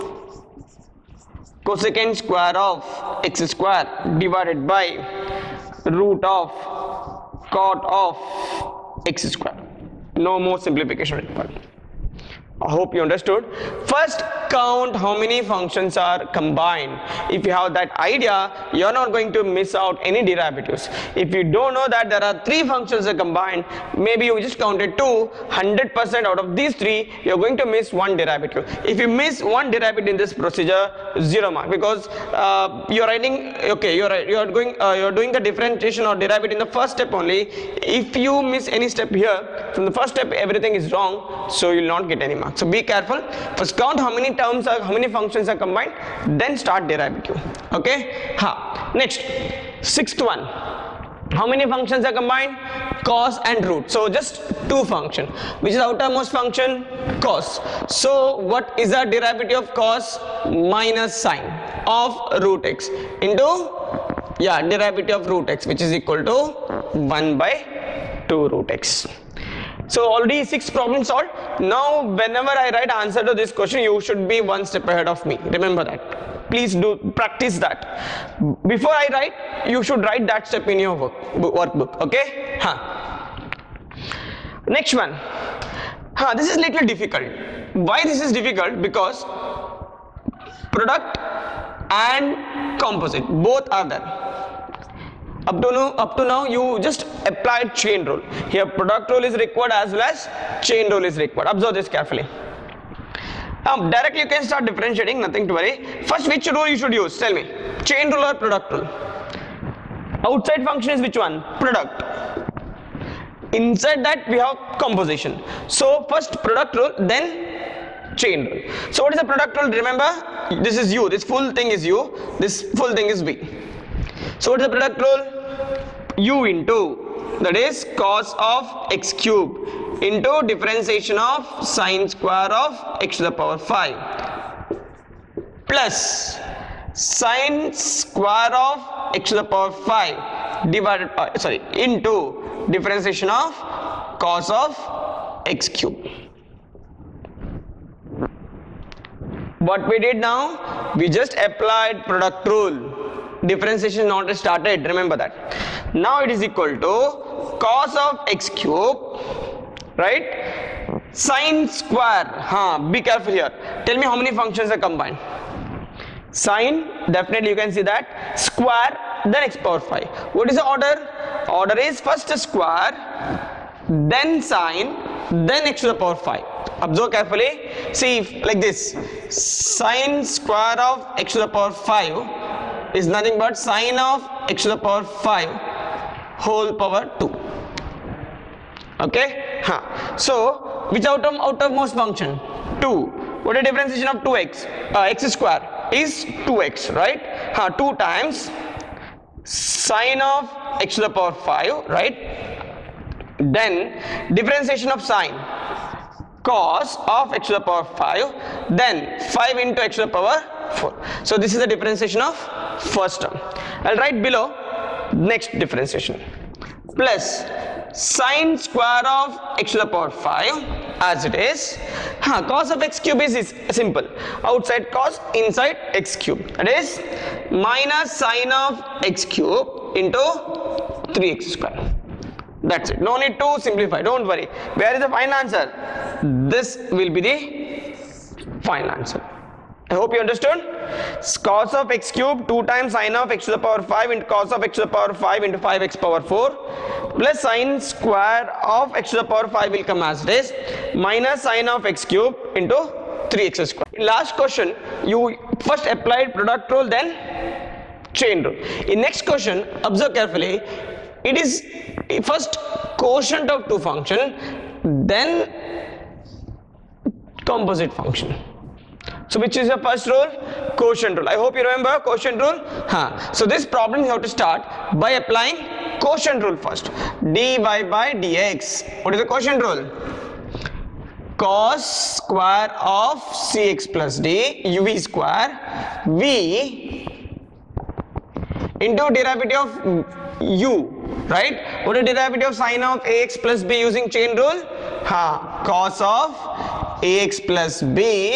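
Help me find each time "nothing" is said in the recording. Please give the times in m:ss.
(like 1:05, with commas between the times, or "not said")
1:45, 3:03.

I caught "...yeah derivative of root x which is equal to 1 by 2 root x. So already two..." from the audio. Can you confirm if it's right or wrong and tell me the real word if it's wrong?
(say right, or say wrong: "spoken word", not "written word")
wrong: "six", not "two".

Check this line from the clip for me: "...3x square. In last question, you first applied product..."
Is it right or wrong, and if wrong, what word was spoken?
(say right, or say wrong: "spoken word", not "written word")
right.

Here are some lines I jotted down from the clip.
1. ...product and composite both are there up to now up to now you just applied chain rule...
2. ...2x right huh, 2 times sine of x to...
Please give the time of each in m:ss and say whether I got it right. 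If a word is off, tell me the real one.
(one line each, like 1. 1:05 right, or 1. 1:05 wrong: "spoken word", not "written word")
1. 1:30 right
2. 3:16 right.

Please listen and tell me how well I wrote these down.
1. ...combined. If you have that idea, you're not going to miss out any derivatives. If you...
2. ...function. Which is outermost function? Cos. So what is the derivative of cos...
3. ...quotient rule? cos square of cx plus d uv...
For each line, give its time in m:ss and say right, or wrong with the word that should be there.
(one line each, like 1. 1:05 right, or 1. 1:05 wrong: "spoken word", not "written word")
1. 0:16 right
2. 0:54 right
3. 4:39 right.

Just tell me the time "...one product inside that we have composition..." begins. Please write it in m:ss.
1:51.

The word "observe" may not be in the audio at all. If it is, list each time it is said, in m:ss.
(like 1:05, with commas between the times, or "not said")
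1:41, 2:56, 4:19.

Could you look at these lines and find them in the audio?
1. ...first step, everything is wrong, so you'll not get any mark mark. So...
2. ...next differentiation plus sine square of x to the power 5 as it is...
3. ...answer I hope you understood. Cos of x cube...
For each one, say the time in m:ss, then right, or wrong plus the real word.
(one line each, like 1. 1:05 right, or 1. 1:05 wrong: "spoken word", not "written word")
1. 0:39 right
2. 3:35 right
3. 3:58 right.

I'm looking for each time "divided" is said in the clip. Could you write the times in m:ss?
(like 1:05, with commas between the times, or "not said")
0:04, 2:20.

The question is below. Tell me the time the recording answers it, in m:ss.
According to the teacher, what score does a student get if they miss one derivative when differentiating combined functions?
0:31.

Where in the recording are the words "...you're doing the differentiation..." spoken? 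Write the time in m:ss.
0:34.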